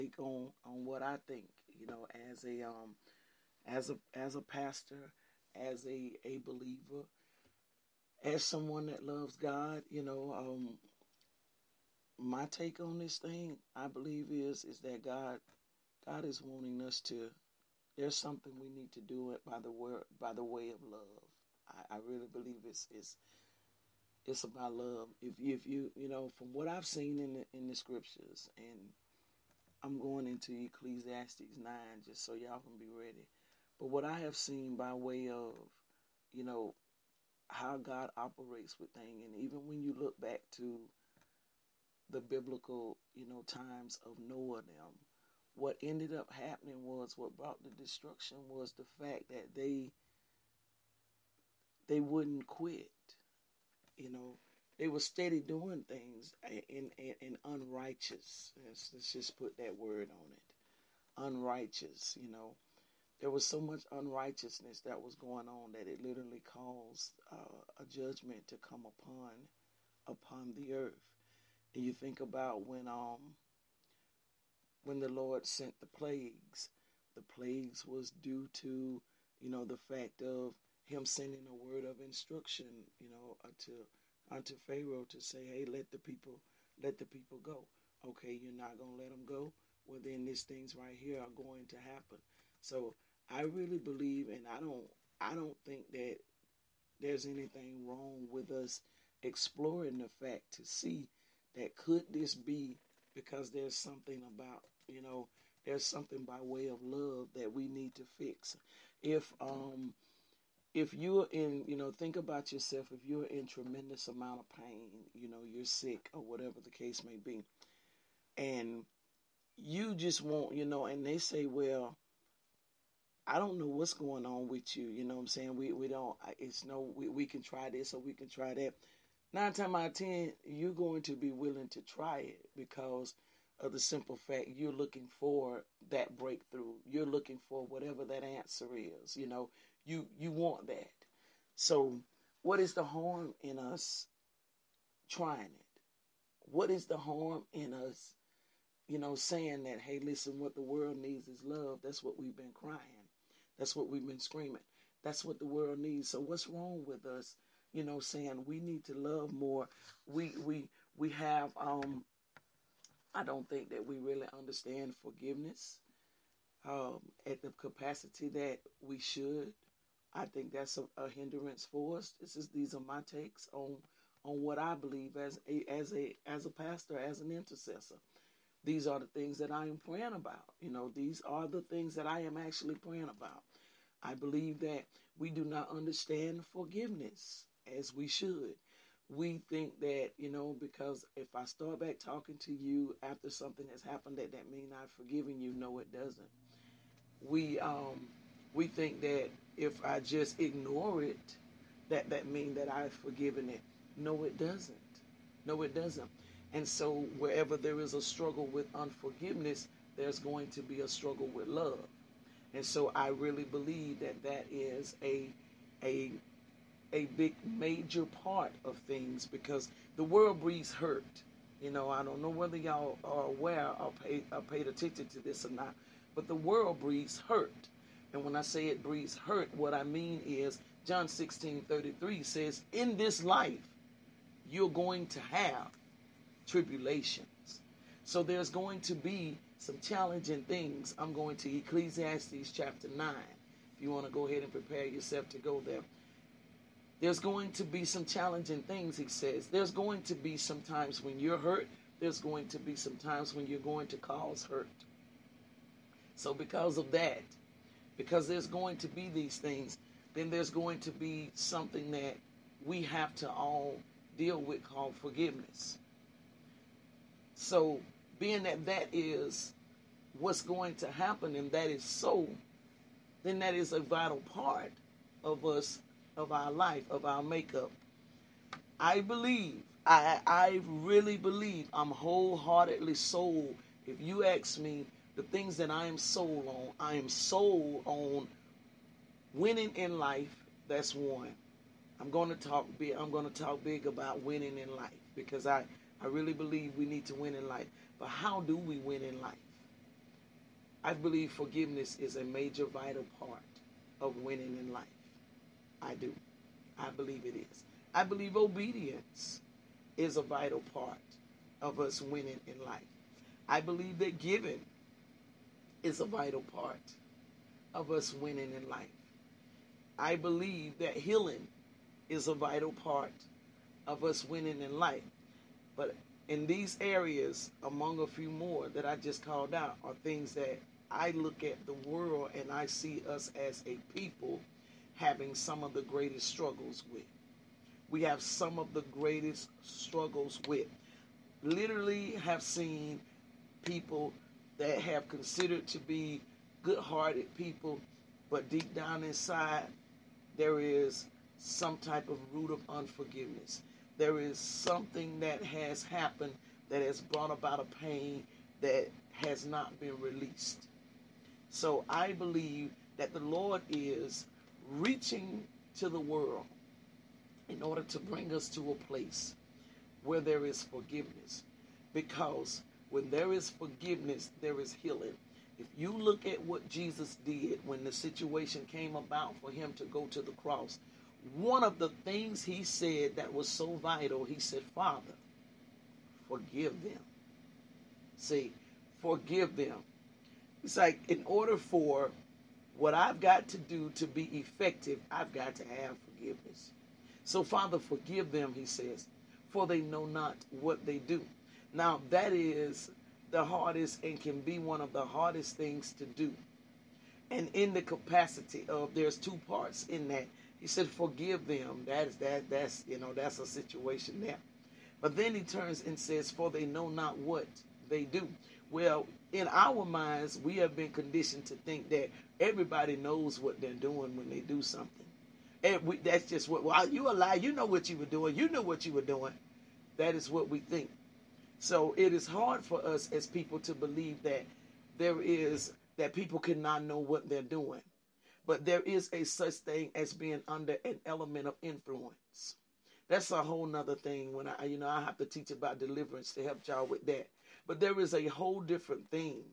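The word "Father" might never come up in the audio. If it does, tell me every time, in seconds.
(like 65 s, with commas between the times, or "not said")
384 s, 397 s.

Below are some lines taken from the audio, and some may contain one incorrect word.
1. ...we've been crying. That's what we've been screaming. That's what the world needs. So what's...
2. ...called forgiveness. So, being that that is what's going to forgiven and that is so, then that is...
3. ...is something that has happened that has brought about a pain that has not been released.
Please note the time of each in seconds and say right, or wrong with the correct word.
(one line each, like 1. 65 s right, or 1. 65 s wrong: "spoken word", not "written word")
1. 152 s right
2. 264 s wrong: "happen", not "forgiven"
3. 354 s right.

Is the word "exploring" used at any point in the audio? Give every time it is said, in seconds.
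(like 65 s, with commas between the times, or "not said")
99 s.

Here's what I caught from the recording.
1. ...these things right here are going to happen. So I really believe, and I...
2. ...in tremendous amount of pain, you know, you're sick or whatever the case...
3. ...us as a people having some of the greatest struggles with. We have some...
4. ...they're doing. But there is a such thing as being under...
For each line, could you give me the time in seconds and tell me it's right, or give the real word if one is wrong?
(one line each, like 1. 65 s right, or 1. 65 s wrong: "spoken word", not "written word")
1. 90 s right
2. 113 s right
3. 333 s right
4. 437 s right.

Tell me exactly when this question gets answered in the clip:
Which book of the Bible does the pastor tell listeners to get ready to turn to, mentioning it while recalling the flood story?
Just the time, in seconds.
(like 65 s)
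30 s.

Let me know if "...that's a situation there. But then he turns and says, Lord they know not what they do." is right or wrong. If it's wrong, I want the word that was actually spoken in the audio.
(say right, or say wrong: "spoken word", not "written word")
wrong: "For", not "Lord".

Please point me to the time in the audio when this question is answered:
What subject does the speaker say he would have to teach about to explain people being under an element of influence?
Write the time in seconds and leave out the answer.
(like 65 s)
445 s.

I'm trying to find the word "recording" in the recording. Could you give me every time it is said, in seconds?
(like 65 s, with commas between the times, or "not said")
not said.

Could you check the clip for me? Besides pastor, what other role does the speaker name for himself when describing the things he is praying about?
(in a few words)
Intercessor.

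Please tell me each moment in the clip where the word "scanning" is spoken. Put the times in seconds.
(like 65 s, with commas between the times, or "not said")
not said.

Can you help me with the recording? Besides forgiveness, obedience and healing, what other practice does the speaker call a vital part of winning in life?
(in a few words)
Giving.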